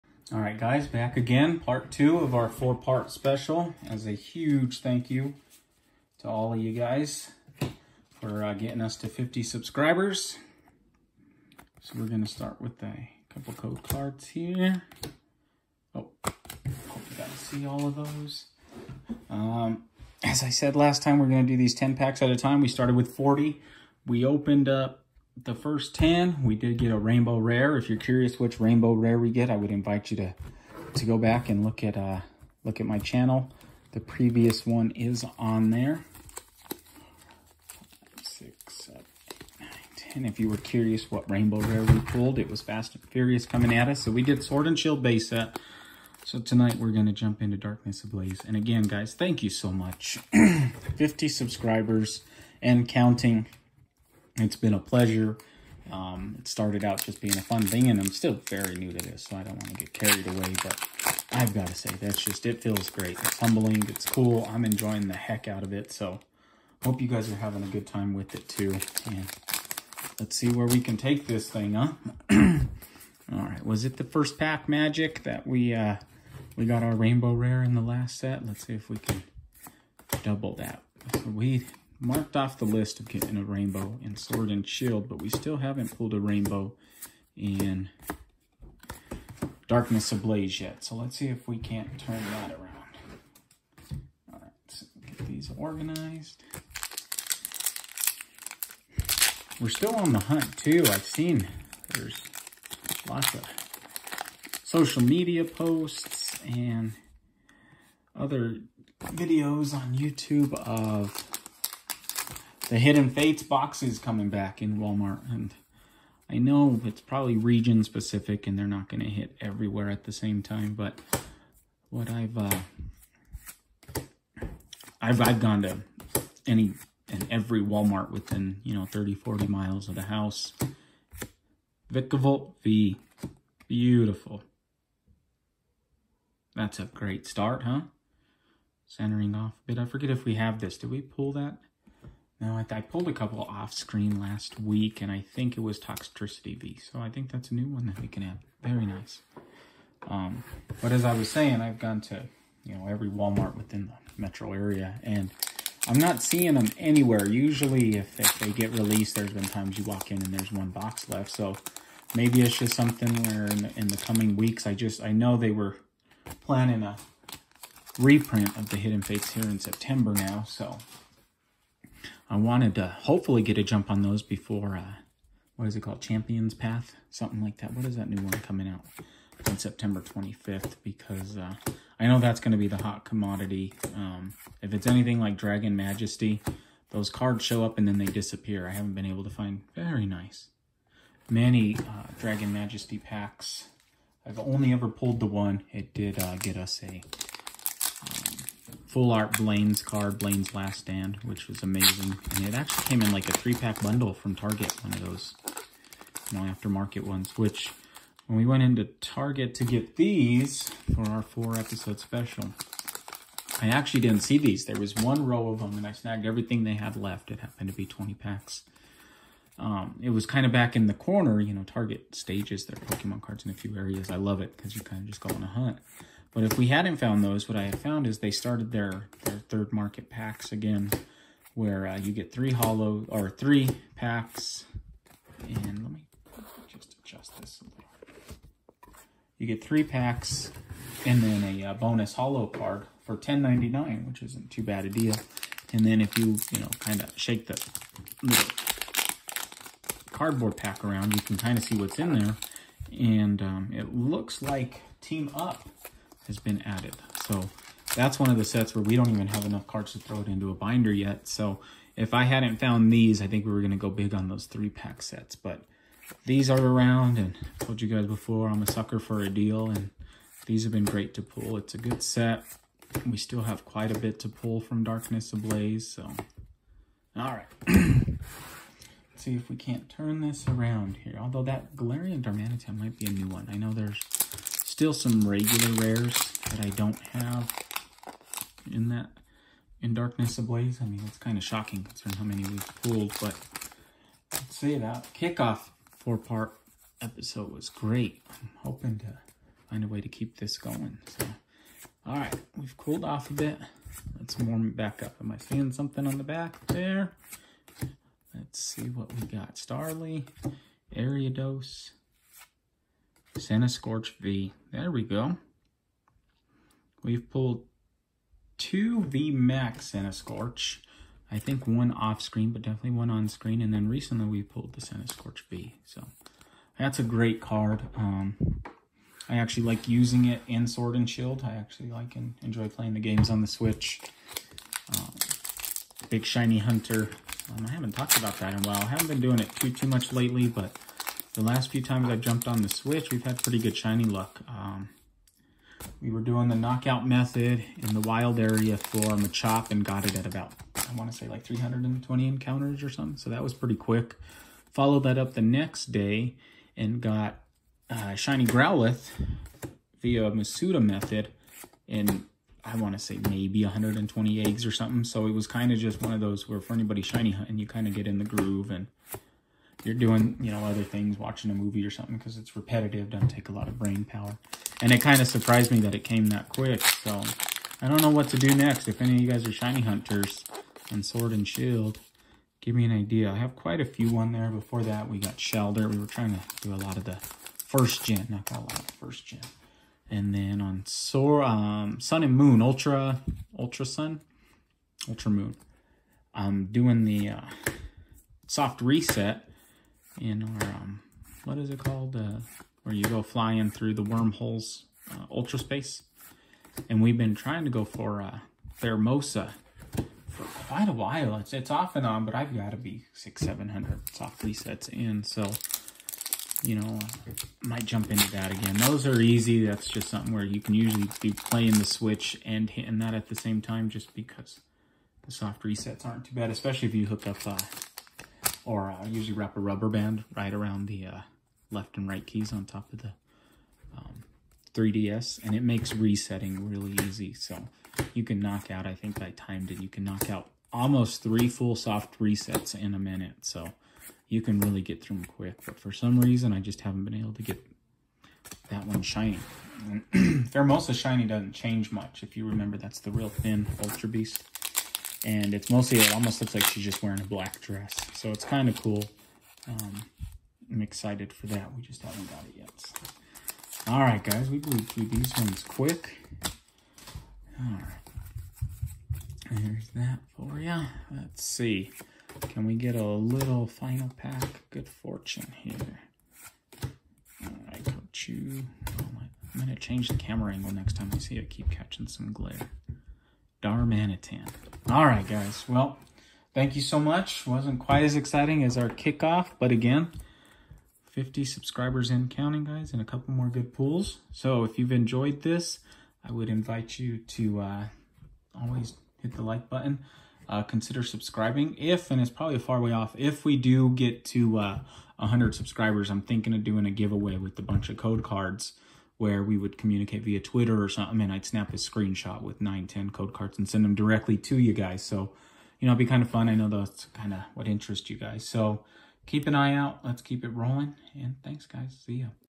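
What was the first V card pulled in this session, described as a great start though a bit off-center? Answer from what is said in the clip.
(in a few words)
Vikavolt V.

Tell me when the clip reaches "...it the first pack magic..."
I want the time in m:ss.
1:13.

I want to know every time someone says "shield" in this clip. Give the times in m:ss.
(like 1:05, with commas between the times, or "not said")
0:44, 1:24, 5:31, 6:21.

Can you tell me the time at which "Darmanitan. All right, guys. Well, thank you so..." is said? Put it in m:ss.
8:03.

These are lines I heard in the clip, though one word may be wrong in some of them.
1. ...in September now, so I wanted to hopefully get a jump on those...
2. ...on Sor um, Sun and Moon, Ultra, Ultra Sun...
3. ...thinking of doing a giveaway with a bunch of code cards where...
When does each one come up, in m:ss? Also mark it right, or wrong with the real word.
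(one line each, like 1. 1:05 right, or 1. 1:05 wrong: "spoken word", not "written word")
1. 2:49 right
2. 6:30 right
3. 8:26 right.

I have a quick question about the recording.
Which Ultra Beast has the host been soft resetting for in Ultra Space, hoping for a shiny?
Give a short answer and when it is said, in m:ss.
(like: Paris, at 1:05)
Pheromosa, at 6:48.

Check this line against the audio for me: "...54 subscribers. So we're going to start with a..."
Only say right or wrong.
wrong.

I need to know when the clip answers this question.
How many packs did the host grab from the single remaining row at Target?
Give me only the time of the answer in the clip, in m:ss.
3:37.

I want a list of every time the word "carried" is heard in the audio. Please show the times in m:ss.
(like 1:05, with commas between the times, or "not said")
0:59.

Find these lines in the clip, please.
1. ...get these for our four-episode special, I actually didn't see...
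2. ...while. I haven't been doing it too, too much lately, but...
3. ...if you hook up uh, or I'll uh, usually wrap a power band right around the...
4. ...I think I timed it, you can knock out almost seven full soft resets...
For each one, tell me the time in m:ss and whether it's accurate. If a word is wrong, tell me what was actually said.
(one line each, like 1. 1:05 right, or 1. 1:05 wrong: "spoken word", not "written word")
1. 3:29 right
2. 5:38 right
3. 7:06 wrong: "rubber", not "power"
4. 7:18 wrong: "three", not "seven".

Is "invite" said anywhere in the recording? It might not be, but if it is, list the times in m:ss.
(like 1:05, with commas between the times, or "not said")
0:29, 8:16.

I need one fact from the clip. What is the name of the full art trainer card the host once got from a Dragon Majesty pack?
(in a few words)
Blaine's Last Stand.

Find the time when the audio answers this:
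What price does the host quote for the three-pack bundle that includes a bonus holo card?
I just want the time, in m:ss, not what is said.
4:03.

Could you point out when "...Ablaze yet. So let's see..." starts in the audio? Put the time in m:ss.
1:30.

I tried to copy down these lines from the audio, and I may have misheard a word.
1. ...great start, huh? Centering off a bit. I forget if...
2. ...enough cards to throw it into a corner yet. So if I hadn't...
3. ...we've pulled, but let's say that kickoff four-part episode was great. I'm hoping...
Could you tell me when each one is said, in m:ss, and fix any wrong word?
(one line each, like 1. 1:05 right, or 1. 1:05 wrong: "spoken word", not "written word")
1. 2:16 right
2. 4:19 wrong: "binder", not "corner"
3. 4:52 right.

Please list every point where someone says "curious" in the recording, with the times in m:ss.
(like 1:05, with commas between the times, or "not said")
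0:27, 0:40.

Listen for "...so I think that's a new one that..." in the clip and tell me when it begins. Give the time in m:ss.
2:26.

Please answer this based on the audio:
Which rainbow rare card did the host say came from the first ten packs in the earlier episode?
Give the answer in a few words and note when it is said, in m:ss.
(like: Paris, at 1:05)
Fast and Furious, at 0:42.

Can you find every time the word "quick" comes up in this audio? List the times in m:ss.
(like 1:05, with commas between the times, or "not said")
5:53, 6:16, 7:25, 7:45.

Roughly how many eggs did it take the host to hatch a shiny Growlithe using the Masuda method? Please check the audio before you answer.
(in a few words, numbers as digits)
120.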